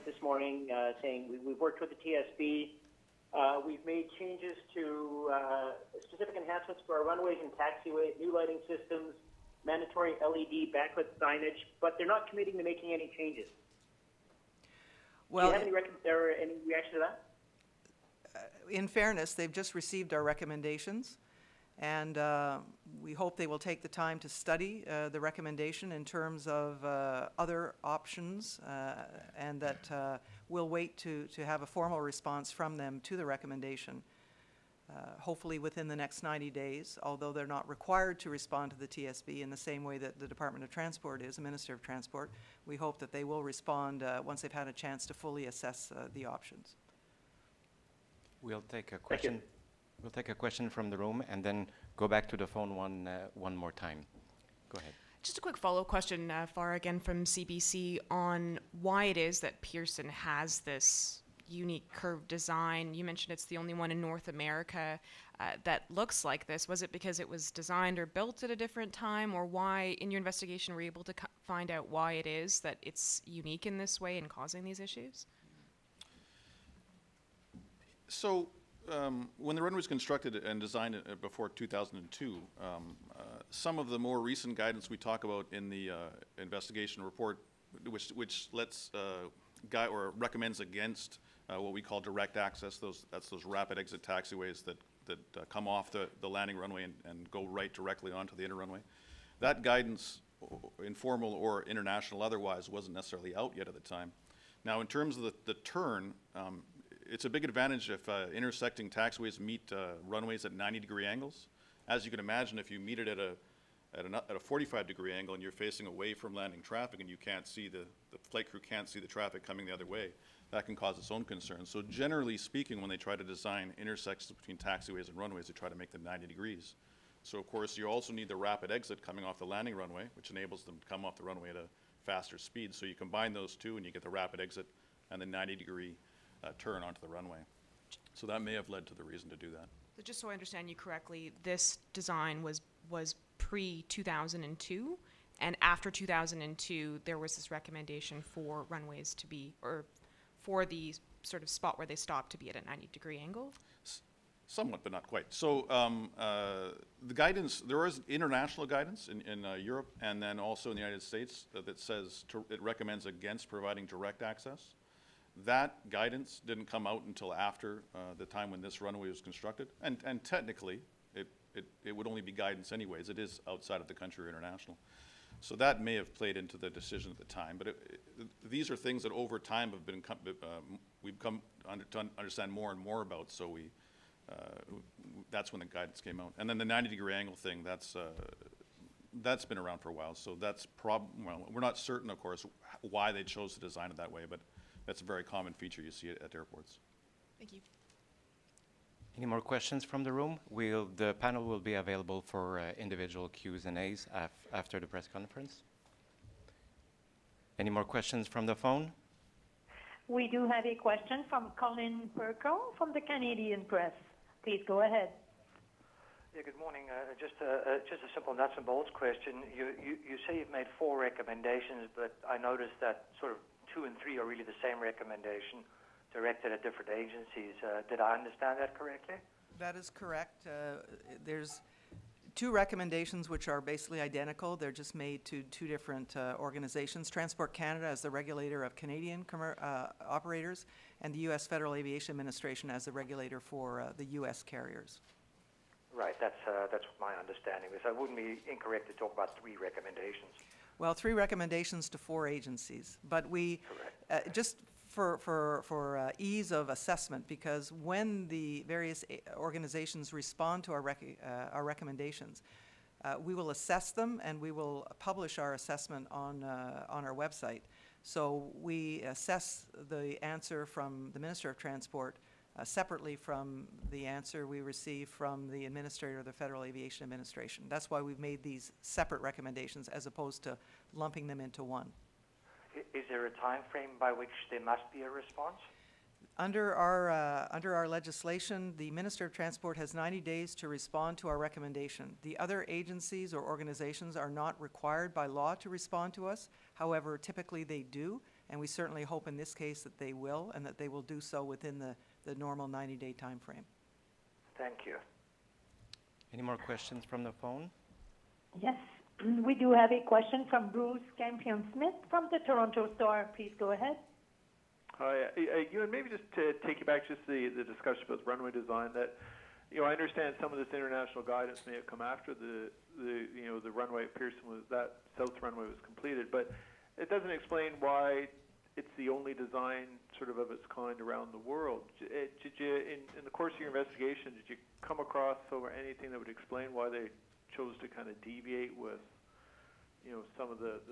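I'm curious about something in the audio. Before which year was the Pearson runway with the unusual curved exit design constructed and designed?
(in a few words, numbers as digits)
2002.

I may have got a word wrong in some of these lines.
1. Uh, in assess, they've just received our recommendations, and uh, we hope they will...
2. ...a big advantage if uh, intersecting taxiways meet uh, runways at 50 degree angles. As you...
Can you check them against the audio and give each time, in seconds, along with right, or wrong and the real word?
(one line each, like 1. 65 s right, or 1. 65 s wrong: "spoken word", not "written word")
1. 18 s wrong: "fairness", not "assess"
2. 107 s wrong: "90", not "50".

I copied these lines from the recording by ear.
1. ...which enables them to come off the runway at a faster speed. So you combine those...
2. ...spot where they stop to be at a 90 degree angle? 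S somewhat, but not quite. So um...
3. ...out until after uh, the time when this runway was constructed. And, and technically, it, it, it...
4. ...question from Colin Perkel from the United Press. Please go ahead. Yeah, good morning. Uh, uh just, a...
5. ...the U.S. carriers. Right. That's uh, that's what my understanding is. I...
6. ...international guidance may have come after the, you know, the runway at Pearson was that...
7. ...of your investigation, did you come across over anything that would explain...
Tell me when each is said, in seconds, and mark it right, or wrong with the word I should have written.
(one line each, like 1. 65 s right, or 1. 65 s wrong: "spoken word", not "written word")
1. 130 s right
2. 151 s right
3. 166 s right
4. 210 s wrong: "Canadian", not "United"
5. 243 s right
6. 320 s right
7. 333 s right.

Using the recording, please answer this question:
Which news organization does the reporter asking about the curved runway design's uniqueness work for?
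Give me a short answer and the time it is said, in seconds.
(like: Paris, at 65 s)
CBC, at 57 s.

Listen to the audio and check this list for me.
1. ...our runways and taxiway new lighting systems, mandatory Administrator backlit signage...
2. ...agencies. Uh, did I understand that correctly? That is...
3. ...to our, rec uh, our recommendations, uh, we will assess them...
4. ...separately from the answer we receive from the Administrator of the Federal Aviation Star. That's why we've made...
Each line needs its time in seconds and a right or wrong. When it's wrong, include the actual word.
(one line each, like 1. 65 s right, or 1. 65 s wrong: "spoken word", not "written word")
1. 6 s wrong: "LED", not "Administrator"
2. 226 s right
3. 260 s right
4. 272 s wrong: "Administration", not "Star".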